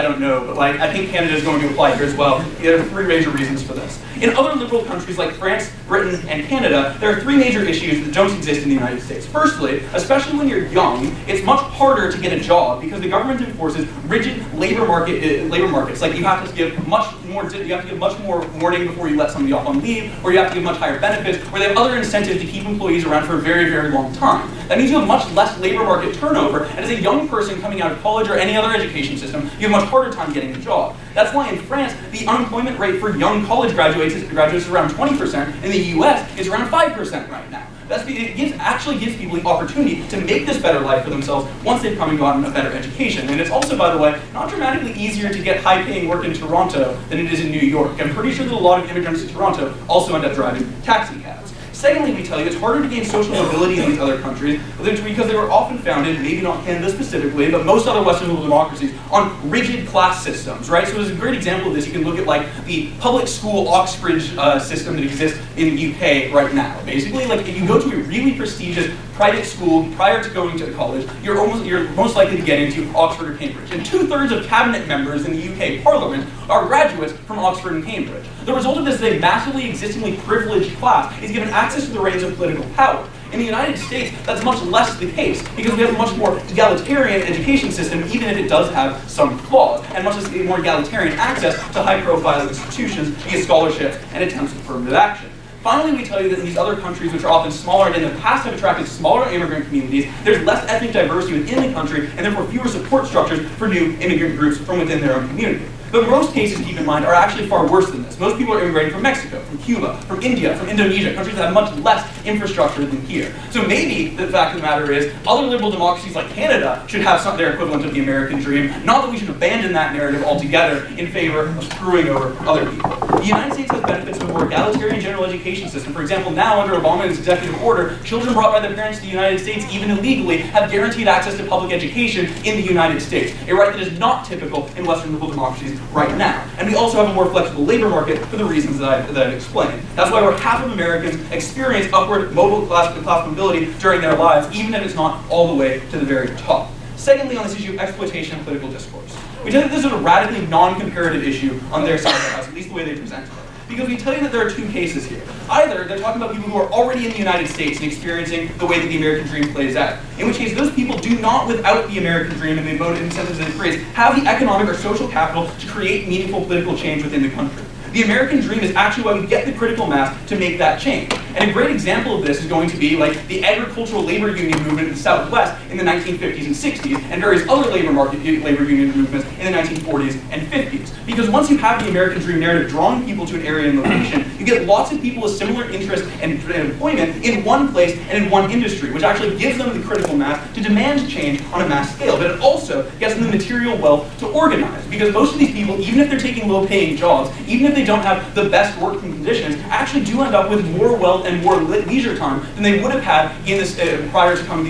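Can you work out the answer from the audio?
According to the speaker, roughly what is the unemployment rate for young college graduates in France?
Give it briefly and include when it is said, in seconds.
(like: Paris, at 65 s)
20%, at 34 s.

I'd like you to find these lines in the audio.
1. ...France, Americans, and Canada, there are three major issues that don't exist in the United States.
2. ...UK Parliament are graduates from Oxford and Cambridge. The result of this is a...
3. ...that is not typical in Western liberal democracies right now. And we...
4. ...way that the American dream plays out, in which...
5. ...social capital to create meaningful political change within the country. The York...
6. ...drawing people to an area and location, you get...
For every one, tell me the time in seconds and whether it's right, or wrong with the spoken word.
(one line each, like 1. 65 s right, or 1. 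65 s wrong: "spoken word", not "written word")
1. 5 s wrong: "Britain", not "Americans"
2. 75 s right
3. 133 s right
4. 158 s right
5. 164 s wrong: "American", not "York"
6. 182 s right.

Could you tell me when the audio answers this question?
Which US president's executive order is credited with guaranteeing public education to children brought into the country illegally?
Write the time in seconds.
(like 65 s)
126 s.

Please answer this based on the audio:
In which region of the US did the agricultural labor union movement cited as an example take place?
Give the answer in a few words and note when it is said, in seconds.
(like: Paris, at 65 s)
The Southwest, at 174 s.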